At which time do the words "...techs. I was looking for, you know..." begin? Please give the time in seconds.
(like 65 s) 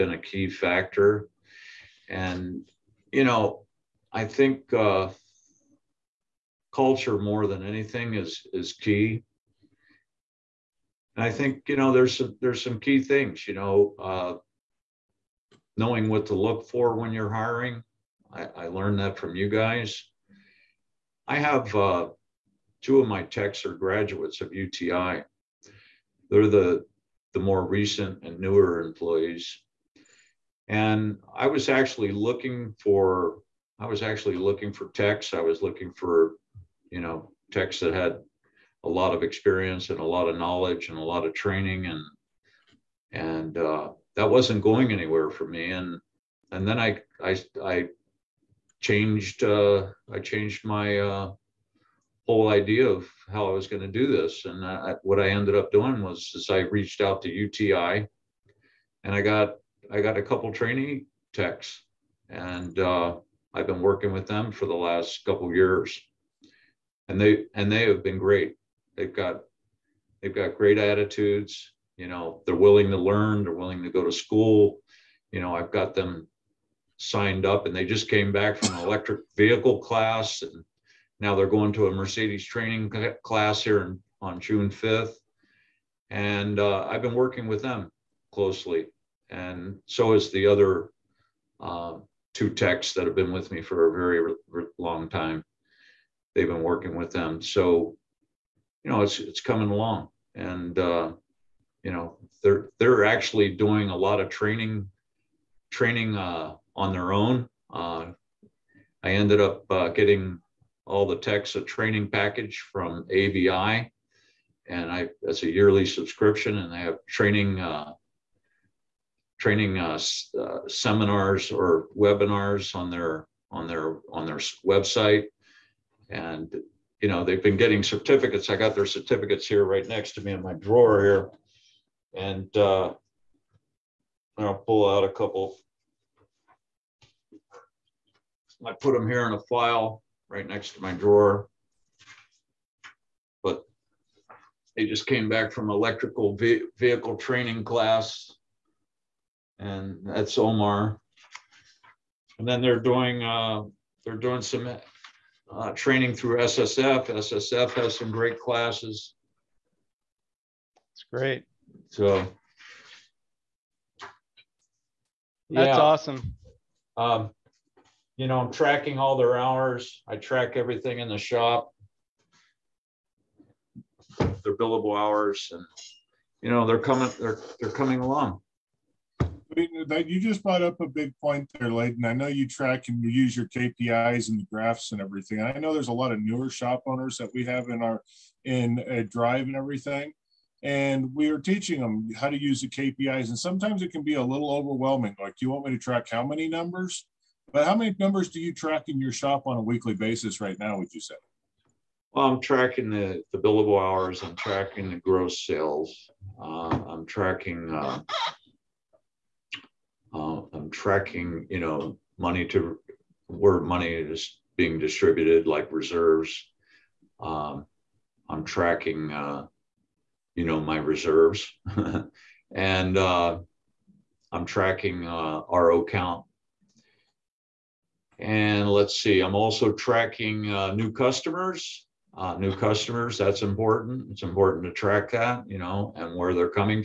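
34 s.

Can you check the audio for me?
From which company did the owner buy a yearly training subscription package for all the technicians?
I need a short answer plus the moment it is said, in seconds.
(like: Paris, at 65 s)
AVI, at 113 s.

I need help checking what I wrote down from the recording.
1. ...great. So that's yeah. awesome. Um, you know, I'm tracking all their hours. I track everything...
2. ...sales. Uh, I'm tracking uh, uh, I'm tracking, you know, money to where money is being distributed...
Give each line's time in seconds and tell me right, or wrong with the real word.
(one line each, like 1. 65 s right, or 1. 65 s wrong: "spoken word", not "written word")
1. 161 s right
2. 205 s right.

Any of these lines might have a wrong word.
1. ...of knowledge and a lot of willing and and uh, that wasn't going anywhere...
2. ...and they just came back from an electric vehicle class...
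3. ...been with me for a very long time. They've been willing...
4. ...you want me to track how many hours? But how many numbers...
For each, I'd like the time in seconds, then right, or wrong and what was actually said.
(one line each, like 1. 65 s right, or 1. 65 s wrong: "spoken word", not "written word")
1. 40 s wrong: "training", not "willing"
2. 77 s right
3. 93 s wrong: "working", not "willing"
4. 195 s wrong: "numbers", not "hours".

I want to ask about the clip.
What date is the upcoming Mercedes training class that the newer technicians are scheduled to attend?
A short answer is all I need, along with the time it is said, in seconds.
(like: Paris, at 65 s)
June 5, at 84 s.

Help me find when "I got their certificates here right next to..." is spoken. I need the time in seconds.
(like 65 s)
128 s.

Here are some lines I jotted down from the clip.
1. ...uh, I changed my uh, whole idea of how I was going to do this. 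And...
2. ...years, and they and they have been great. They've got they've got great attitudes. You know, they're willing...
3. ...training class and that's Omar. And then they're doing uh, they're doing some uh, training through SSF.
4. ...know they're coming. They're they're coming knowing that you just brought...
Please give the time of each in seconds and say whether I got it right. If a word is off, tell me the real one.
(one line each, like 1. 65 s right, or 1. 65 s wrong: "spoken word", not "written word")
1. 49 s right
2. 65 s right
3. 147 s right
4. 176 s wrong: "along", not "knowing".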